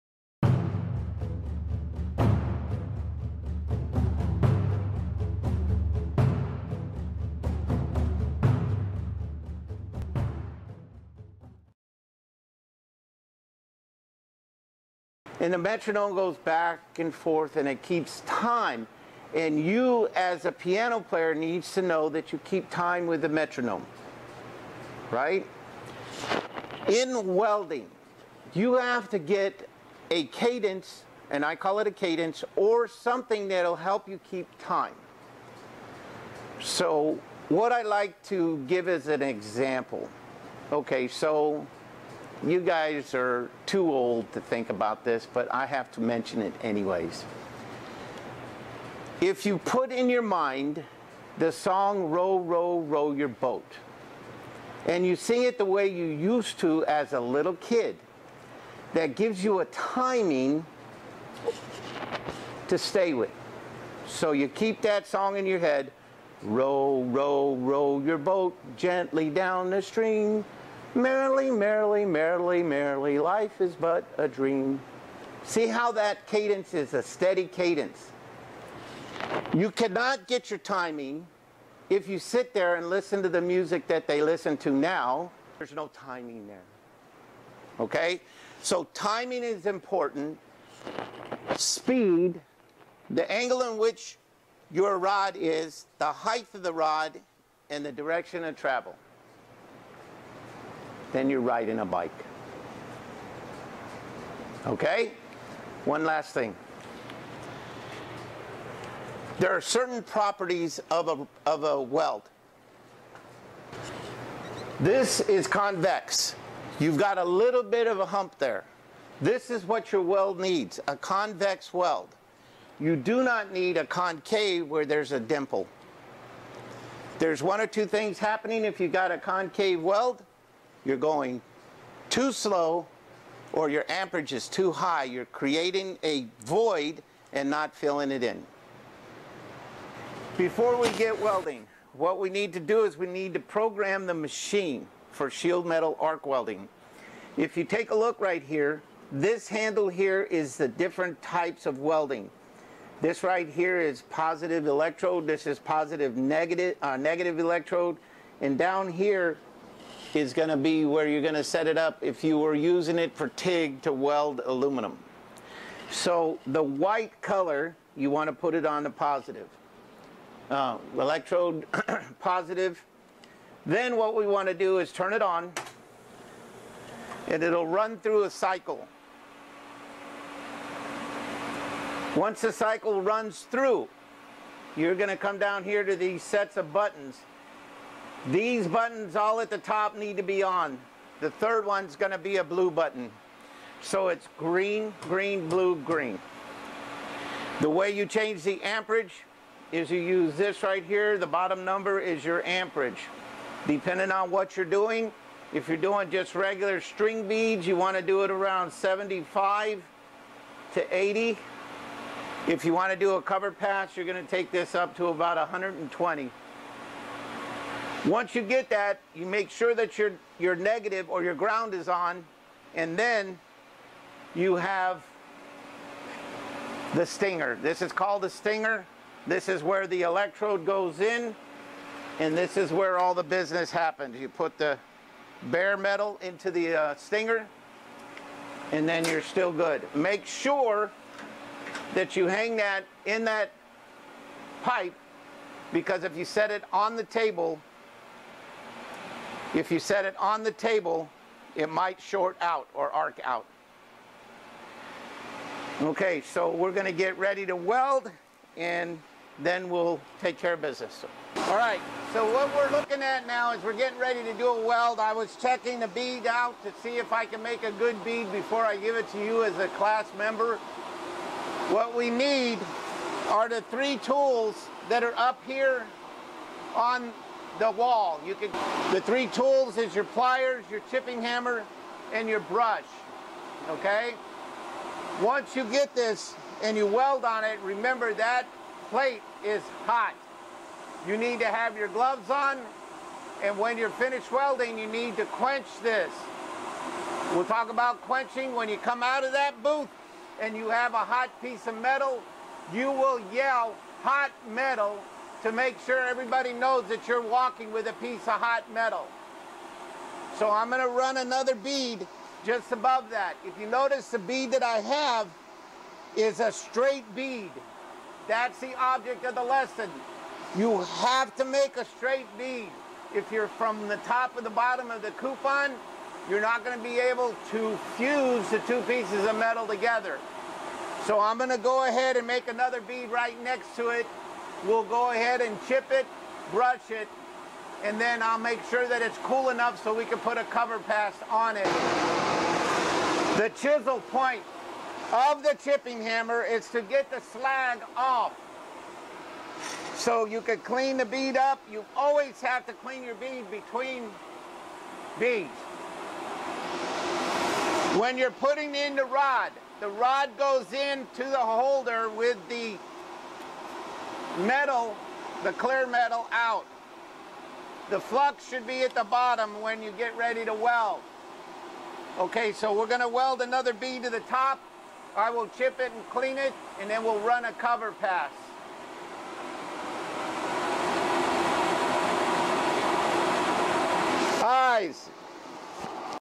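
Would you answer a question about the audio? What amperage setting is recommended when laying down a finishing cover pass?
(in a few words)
120.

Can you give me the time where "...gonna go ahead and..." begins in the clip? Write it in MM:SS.
05:31.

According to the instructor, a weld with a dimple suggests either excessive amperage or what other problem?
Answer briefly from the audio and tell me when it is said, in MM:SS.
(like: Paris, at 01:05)
going too slow, at 02:10.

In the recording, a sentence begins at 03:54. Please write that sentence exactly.
You put the bare metal into the uh, stinger, and then you're still good.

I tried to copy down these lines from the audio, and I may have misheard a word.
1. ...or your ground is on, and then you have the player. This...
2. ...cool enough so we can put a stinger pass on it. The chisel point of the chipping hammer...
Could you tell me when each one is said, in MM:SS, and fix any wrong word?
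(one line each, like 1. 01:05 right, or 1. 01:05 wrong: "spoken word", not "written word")
1. 03:41 wrong: "stinger", not "player"
2. 05:39 wrong: "cover", not "stinger".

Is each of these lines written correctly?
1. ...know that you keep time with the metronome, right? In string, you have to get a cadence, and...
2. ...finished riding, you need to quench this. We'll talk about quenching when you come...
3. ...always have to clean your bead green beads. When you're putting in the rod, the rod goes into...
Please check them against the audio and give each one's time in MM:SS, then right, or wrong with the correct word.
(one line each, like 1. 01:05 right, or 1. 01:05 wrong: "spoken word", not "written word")
1. 00:21 wrong: "welding", not "string"
2. 04:53 wrong: "welding", not "riding"
3. 05:51 wrong: "between", not "green".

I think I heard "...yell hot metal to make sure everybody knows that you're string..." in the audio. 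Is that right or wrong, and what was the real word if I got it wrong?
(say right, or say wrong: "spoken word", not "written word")
wrong: "walking", not "string".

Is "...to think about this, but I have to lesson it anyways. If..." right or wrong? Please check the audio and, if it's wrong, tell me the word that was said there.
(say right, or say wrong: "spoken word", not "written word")
wrong: "mention", not "lesson".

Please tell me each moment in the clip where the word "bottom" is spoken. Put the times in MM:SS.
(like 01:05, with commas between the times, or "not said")
03:21, 05:24, 06:09.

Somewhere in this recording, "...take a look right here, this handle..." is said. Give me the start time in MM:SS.
02:27.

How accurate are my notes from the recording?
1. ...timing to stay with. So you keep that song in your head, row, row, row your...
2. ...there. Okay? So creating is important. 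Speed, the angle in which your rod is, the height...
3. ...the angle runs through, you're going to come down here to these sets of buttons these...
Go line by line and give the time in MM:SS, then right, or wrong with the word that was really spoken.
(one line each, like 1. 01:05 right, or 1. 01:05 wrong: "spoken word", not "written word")
1. 00:59 right
2. 01:26 wrong: "timing", not "creating"
3. 03:02 wrong: "cycle", not "angle".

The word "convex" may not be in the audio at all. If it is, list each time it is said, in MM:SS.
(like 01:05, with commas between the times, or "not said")
01:55, 02:00.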